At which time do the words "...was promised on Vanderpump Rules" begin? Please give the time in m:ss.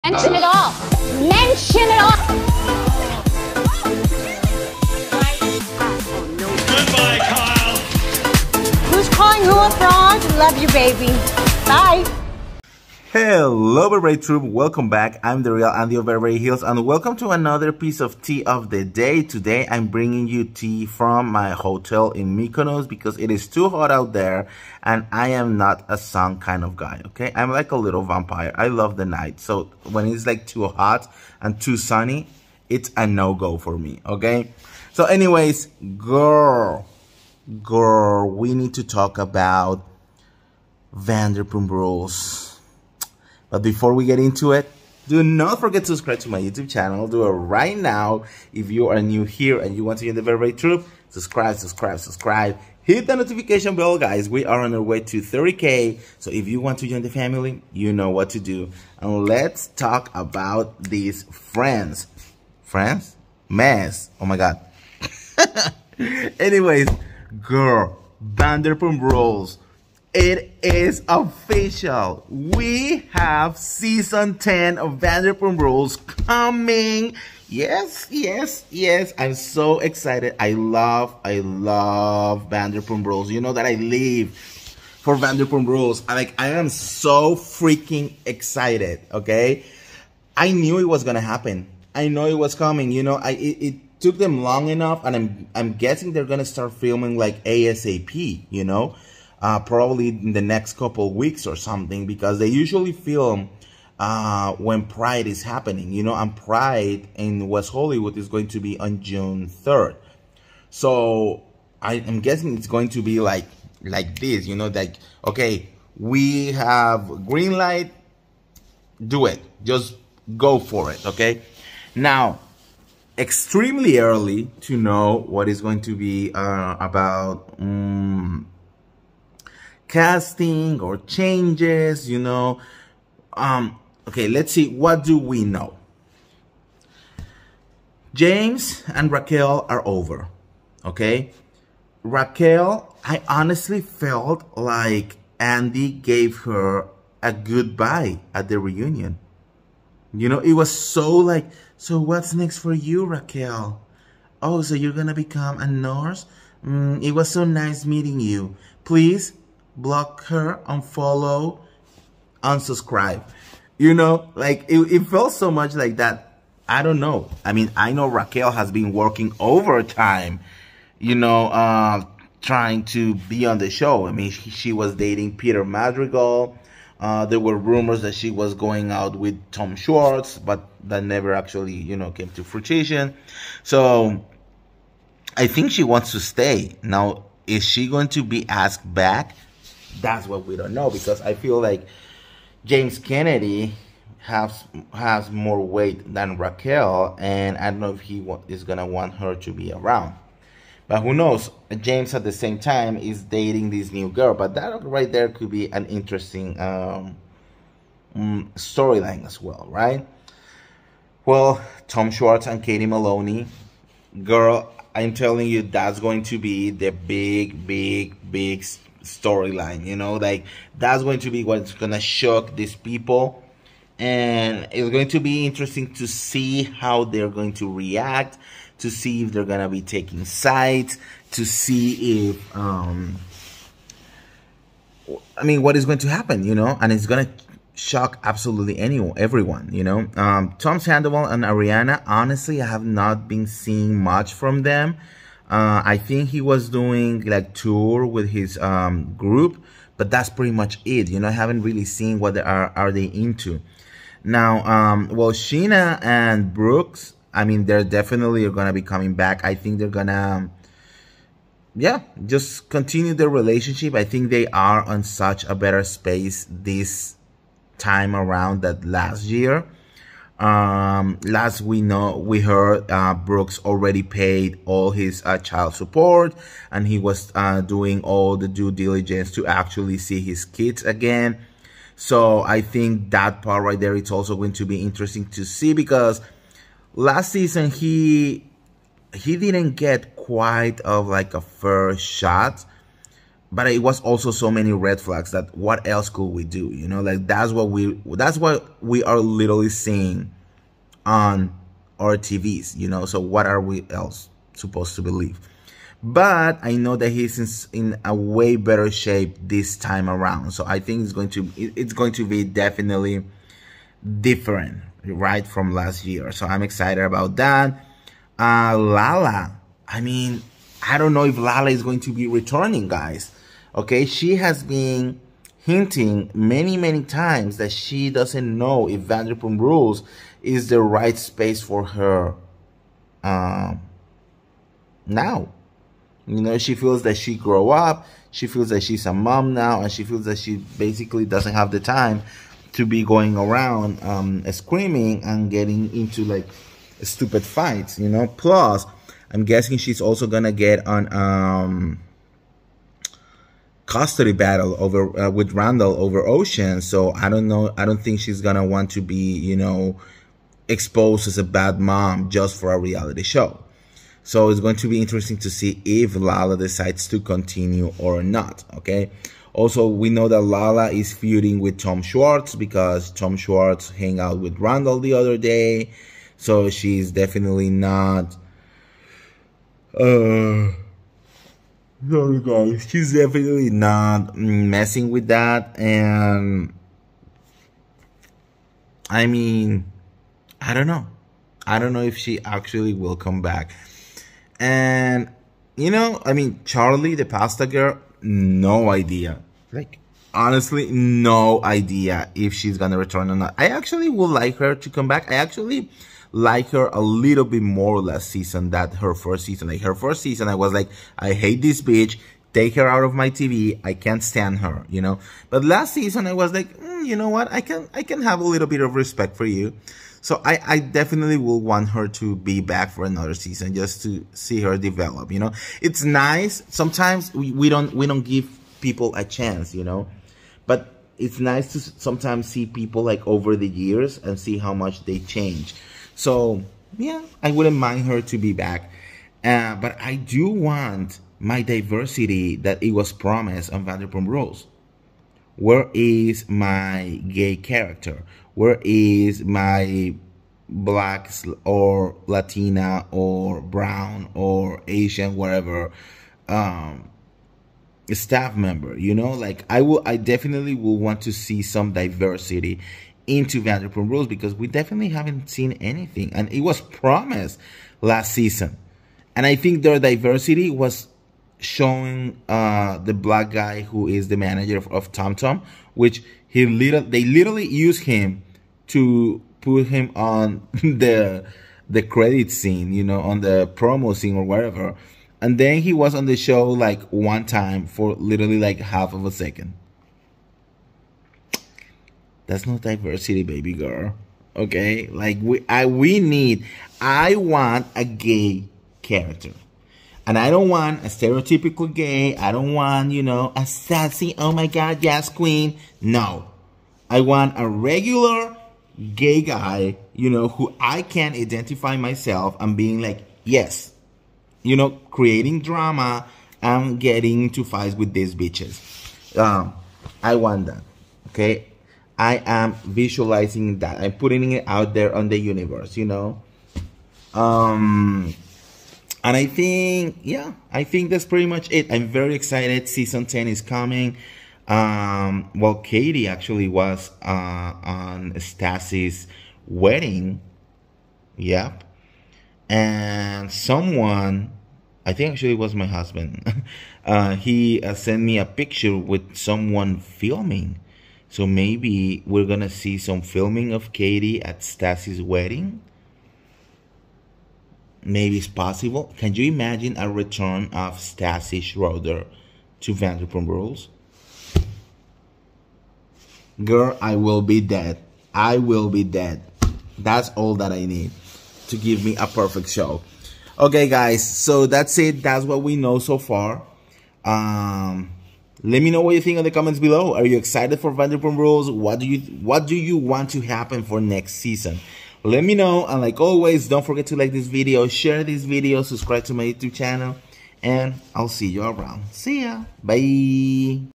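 7:22.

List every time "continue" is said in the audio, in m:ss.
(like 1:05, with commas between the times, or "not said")
4:22, 6:07.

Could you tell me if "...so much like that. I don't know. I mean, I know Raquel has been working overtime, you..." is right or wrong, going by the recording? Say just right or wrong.
right.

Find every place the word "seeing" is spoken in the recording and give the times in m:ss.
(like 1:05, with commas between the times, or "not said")
4:03, 4:59.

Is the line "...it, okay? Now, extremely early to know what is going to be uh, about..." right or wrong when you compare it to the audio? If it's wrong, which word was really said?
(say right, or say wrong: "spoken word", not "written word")
right.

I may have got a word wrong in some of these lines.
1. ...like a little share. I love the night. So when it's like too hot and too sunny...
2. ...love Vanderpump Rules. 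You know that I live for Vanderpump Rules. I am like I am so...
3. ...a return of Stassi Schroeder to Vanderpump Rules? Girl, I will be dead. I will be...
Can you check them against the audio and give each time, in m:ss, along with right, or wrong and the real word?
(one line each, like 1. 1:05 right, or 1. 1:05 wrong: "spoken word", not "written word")
1. 0:27 wrong: "vampire", not "share"
2. 1:21 right
3. 9:19 right.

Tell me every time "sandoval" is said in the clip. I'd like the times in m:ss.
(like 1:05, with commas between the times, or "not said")
4:00.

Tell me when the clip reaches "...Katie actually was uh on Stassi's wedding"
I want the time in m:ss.
8:55.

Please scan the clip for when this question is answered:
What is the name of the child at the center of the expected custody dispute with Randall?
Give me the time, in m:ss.
5:56.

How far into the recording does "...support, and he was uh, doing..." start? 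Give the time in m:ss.
4:35.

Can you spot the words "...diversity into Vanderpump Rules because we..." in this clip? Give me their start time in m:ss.
7:41.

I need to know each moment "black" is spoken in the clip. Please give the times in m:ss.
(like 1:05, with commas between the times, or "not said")
7:30, 7:53.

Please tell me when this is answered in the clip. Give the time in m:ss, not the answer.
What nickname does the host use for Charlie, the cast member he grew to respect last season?
6:37.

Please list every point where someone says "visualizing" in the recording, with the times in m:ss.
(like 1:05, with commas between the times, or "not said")
8:42.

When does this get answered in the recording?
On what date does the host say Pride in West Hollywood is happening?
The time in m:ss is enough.
1:49.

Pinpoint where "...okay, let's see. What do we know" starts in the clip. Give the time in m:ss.
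2:14.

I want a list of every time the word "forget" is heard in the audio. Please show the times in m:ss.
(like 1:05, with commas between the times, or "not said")
0:45, 9:46.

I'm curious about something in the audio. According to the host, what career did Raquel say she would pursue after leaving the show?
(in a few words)
Nurse.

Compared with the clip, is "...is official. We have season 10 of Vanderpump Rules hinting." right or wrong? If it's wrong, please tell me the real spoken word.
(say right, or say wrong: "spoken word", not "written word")
wrong: "coming", not "hinting".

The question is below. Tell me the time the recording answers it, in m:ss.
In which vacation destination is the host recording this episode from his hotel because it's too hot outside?
0:22.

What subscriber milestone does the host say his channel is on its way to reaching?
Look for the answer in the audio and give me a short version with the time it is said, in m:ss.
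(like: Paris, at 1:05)
30K, at 0:55.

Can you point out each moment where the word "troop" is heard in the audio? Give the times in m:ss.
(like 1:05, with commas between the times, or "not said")
0:14, 0:50.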